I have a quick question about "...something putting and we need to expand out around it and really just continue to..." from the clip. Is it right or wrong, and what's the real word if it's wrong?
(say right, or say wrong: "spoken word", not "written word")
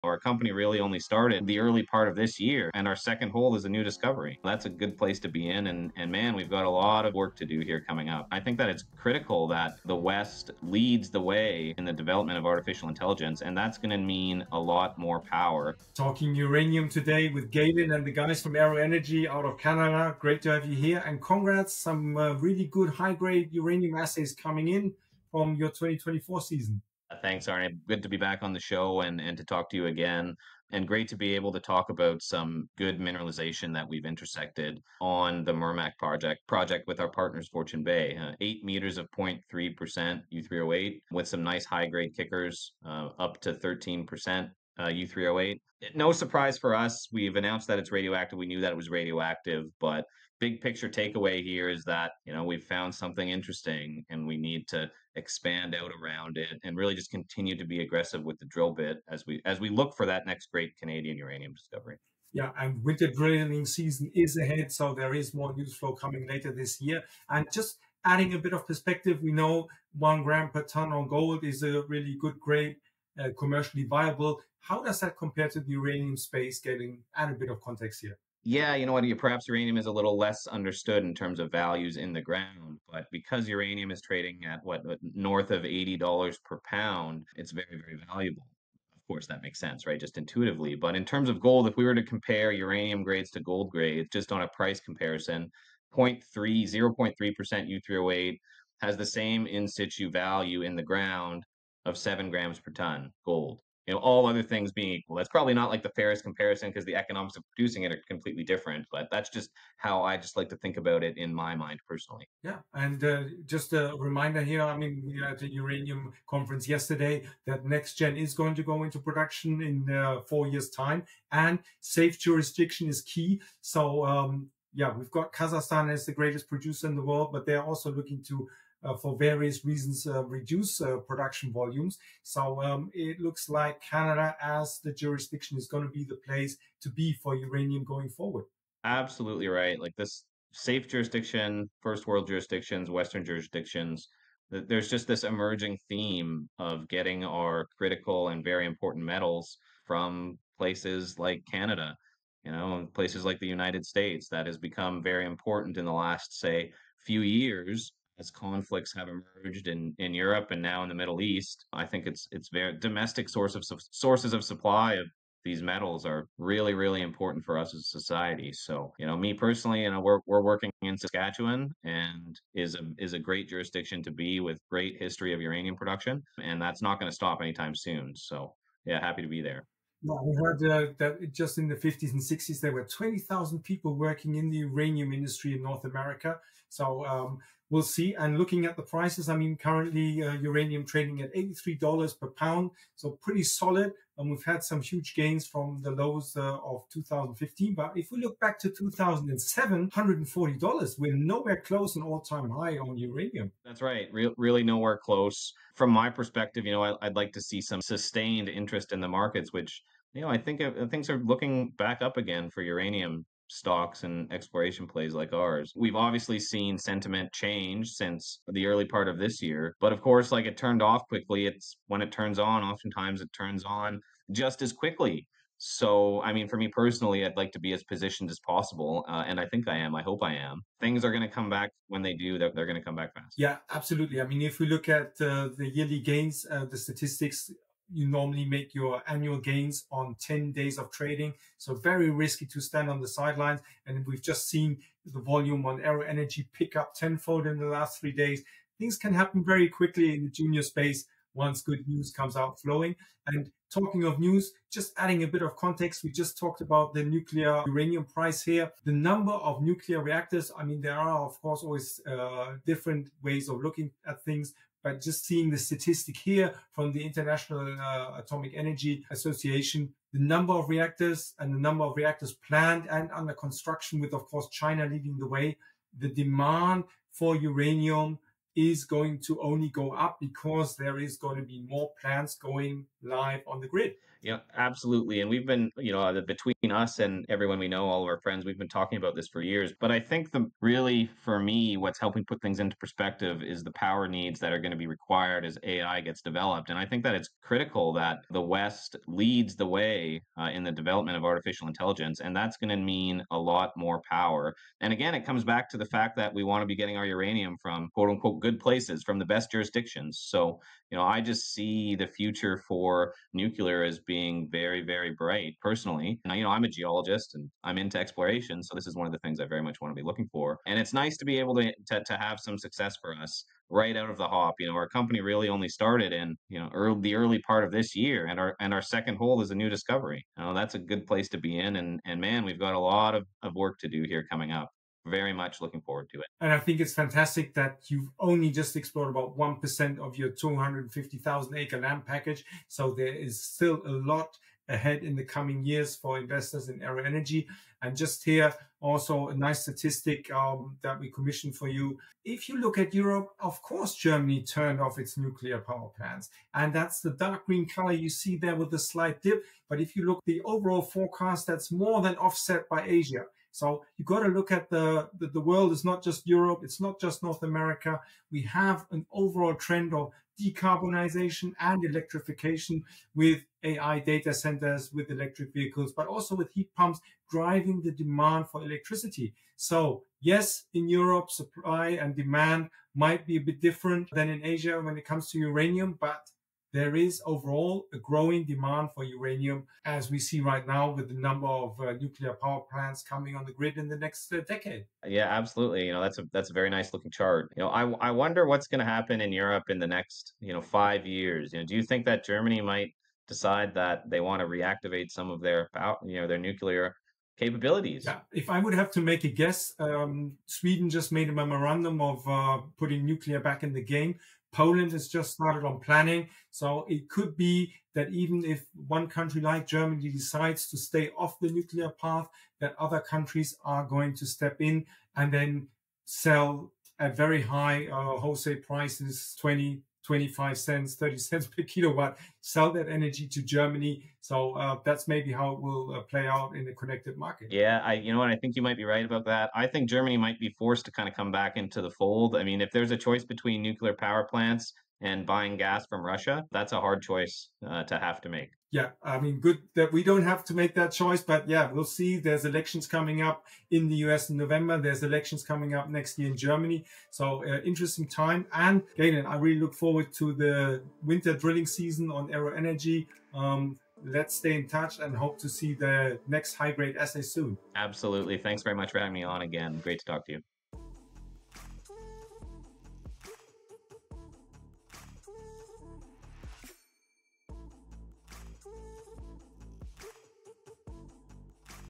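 wrong: "interesting", not "putting".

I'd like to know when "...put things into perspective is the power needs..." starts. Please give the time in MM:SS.
04:52.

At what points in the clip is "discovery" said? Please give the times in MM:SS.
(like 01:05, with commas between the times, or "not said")
00:03, 01:01, 05:29.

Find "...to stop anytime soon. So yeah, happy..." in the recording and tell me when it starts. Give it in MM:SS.
02:57.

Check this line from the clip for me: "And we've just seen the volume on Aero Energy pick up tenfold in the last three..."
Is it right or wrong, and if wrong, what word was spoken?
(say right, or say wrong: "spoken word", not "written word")
right.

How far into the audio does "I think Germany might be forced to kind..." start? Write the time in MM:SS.
07:19.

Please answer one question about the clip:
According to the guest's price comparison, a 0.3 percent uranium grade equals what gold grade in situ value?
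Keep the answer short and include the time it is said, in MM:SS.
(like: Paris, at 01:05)
7 grams per ton, at 01:41.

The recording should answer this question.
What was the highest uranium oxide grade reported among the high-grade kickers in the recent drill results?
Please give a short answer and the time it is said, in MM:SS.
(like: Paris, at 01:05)
13%, at 00:43.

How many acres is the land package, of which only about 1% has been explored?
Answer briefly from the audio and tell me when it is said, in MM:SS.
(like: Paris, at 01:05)
250,000 acres, at 05:40.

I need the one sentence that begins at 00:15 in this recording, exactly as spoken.
Talking uranium today with Galen and the guys from Aero Energy out of Canada.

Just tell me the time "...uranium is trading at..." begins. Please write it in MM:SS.
01:23.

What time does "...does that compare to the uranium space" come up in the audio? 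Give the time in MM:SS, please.
01:14.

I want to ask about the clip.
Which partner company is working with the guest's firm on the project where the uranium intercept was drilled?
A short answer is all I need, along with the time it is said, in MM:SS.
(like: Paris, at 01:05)
Fortune Bay, at 00:37.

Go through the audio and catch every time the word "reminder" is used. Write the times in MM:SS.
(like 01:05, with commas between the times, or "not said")
01:53.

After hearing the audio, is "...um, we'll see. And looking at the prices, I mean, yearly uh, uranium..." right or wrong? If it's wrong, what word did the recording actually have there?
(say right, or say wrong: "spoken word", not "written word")
wrong: "currently", not "yearly".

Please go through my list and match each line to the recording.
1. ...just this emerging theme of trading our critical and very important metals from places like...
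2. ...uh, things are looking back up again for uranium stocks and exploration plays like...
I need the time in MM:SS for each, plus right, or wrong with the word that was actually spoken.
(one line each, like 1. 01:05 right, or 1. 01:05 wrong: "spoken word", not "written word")
1. 02:24 wrong: "getting", not "trading"
2. 03:30 right.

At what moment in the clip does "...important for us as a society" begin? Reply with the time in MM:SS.
02:47.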